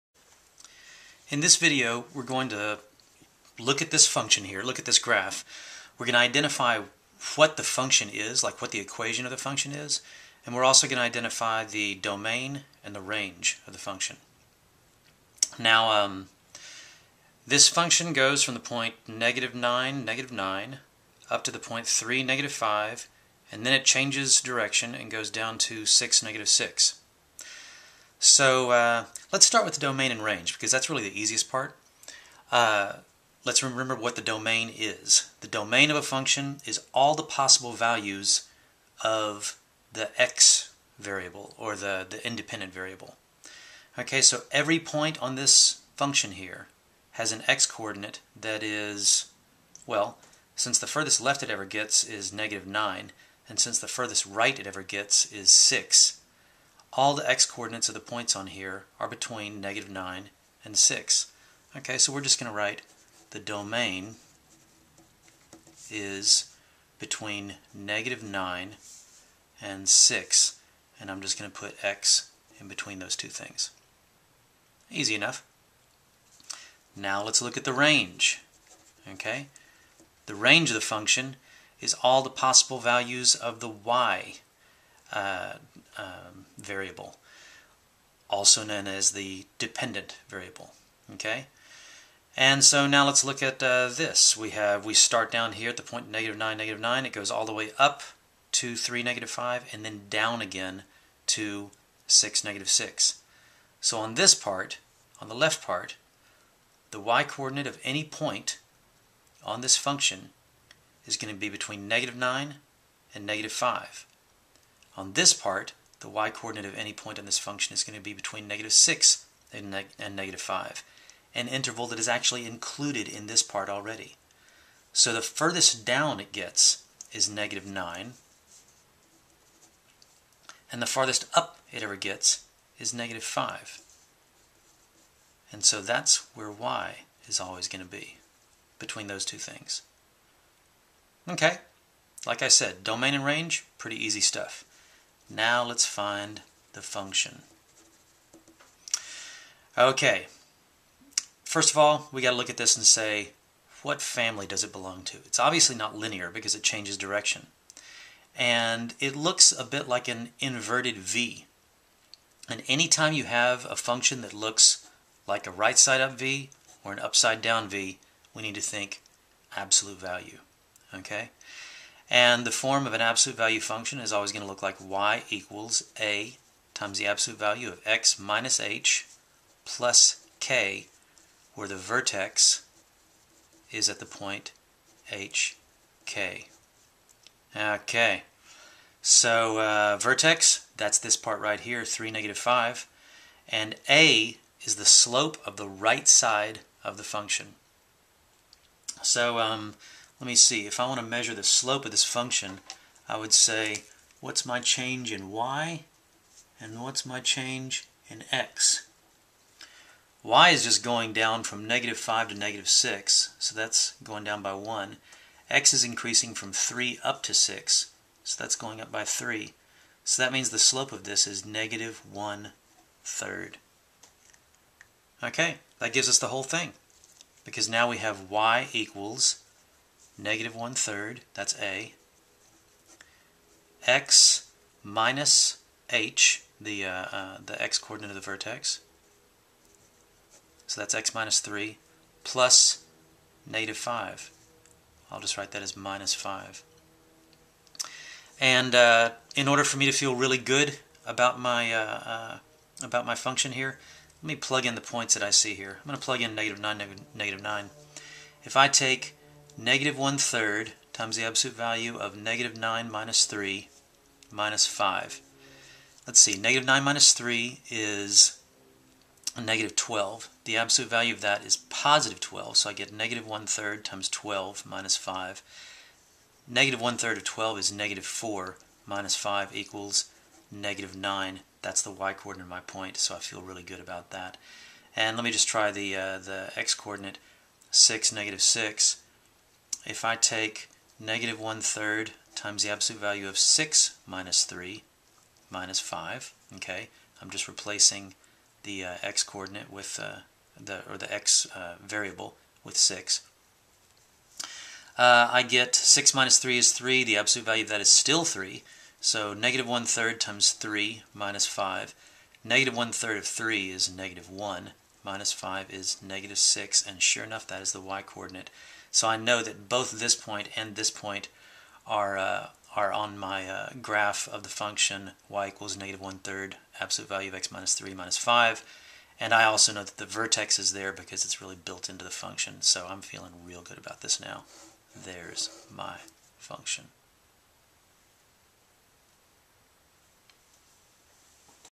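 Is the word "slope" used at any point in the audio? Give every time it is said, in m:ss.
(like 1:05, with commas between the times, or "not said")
3:14, 3:21, 3:40.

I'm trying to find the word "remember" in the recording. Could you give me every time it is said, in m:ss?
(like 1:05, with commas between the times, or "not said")
0:33.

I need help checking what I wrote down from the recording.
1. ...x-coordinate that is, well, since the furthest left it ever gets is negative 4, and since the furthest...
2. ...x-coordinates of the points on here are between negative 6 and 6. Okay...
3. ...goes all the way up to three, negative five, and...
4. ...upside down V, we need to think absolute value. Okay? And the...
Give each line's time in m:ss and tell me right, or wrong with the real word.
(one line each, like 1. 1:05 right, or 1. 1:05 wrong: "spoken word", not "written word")
1. 0:47 wrong: "9", not "4"
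2. 0:57 wrong: "9", not "6"
3. 1:37 right
4. 2:46 right.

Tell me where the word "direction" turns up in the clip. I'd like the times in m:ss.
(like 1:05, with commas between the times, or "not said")
0:24, 2:36.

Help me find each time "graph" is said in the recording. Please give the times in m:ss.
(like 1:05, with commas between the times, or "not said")
0:04, 5:23.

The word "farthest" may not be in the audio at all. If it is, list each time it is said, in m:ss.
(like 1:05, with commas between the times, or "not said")
2:10.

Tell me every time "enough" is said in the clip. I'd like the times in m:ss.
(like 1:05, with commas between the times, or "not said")
1:15, 5:17.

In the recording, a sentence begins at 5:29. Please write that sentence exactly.
And I also know that the vertex is there because it's really built into the function.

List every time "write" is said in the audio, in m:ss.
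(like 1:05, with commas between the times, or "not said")
1:02, 4:05.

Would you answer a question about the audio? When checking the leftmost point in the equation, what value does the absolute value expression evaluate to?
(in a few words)
12.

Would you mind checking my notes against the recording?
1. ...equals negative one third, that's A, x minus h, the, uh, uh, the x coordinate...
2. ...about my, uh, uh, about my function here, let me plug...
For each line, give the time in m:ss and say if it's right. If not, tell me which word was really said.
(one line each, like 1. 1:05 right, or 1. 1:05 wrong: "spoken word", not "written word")
1. 3:48 right
2. 4:11 right.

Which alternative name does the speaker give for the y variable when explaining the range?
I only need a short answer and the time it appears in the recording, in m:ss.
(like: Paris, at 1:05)
dependent variable, at 1:29.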